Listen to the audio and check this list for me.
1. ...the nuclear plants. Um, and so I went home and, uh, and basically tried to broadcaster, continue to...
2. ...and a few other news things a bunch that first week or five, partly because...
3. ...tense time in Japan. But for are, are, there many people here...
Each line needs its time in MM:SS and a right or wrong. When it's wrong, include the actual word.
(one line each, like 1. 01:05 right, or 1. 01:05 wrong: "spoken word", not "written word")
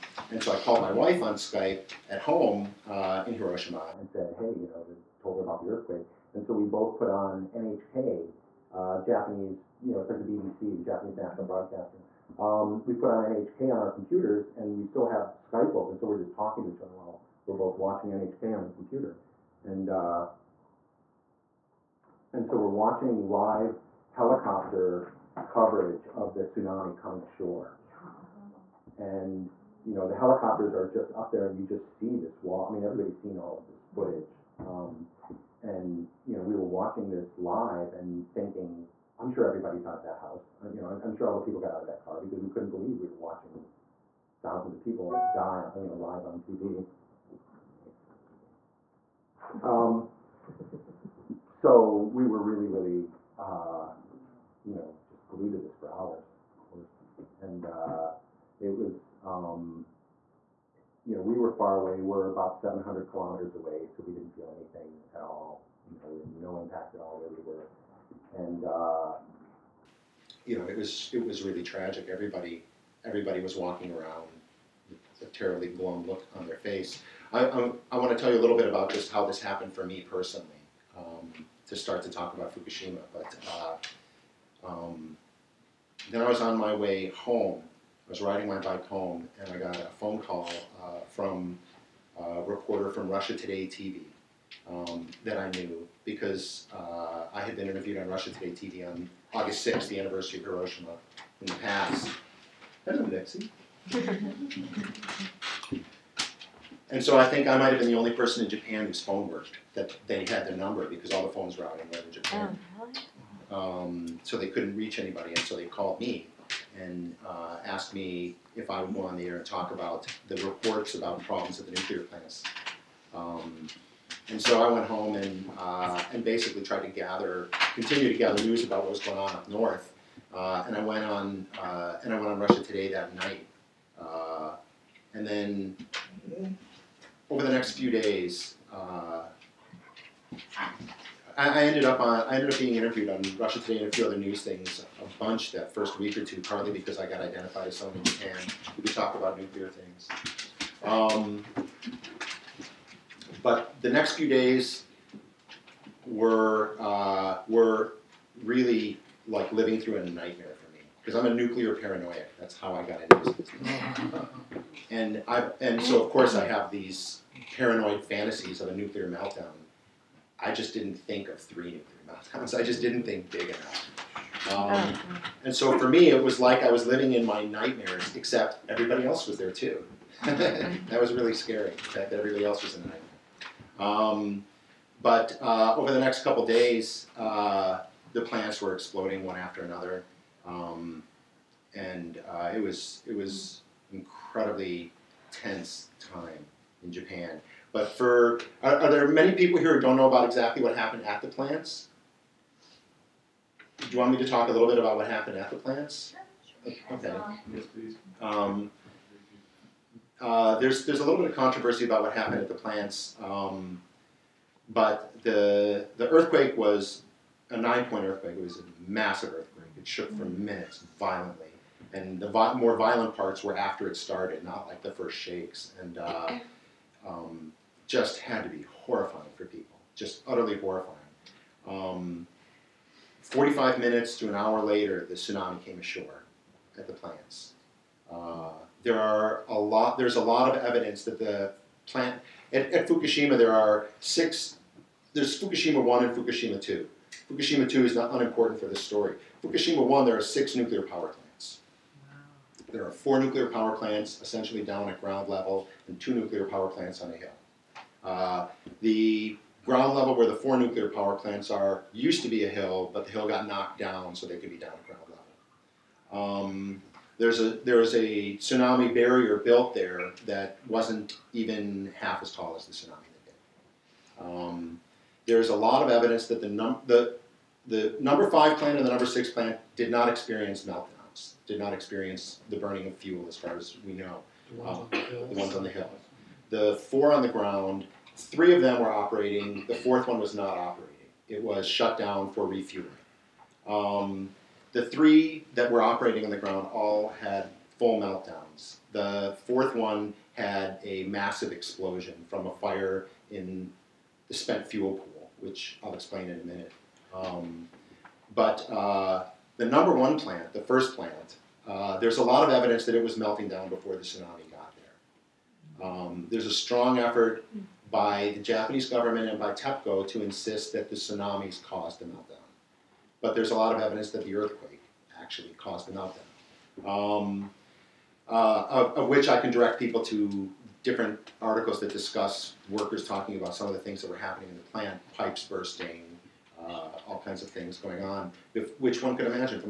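1. 02:01 wrong: "gather", not "broadcaster"
2. 02:23 wrong: "two", not "five"
3. 03:15 right.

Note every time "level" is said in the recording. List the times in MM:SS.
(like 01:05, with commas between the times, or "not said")
04:15, 04:19, 04:26.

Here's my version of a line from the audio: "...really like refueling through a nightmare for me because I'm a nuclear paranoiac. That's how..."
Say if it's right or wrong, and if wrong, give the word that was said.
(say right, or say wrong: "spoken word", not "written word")
wrong: "living", not "refueling".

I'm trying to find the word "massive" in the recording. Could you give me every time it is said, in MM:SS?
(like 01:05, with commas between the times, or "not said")
03:38, 05:01.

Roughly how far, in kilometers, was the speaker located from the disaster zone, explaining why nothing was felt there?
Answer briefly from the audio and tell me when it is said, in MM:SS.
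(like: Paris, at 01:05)
700 kilometers, at 01:02.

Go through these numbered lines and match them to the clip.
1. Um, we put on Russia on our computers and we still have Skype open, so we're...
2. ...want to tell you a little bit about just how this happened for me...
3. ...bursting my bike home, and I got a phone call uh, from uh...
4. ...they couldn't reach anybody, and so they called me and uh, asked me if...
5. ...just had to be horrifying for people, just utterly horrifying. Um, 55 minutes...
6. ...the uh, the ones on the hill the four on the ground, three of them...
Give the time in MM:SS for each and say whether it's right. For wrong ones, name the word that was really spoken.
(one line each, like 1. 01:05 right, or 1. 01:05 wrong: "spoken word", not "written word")
1. 00:12 wrong: "NHK", not "Russia"
2. 01:17 right
3. 01:28 wrong: "riding", not "bursting"
4. 01:54 right
5. 03:47 wrong: "45", not "55"
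6. 04:44 right.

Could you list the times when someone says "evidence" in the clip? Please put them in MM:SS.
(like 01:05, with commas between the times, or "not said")
04:00, 04:35, 05:12, 05:23.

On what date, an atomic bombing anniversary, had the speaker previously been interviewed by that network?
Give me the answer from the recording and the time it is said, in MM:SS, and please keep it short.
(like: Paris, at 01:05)
August 6th, at 01:39.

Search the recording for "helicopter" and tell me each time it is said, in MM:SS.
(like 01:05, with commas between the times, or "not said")
00:24, 00:30.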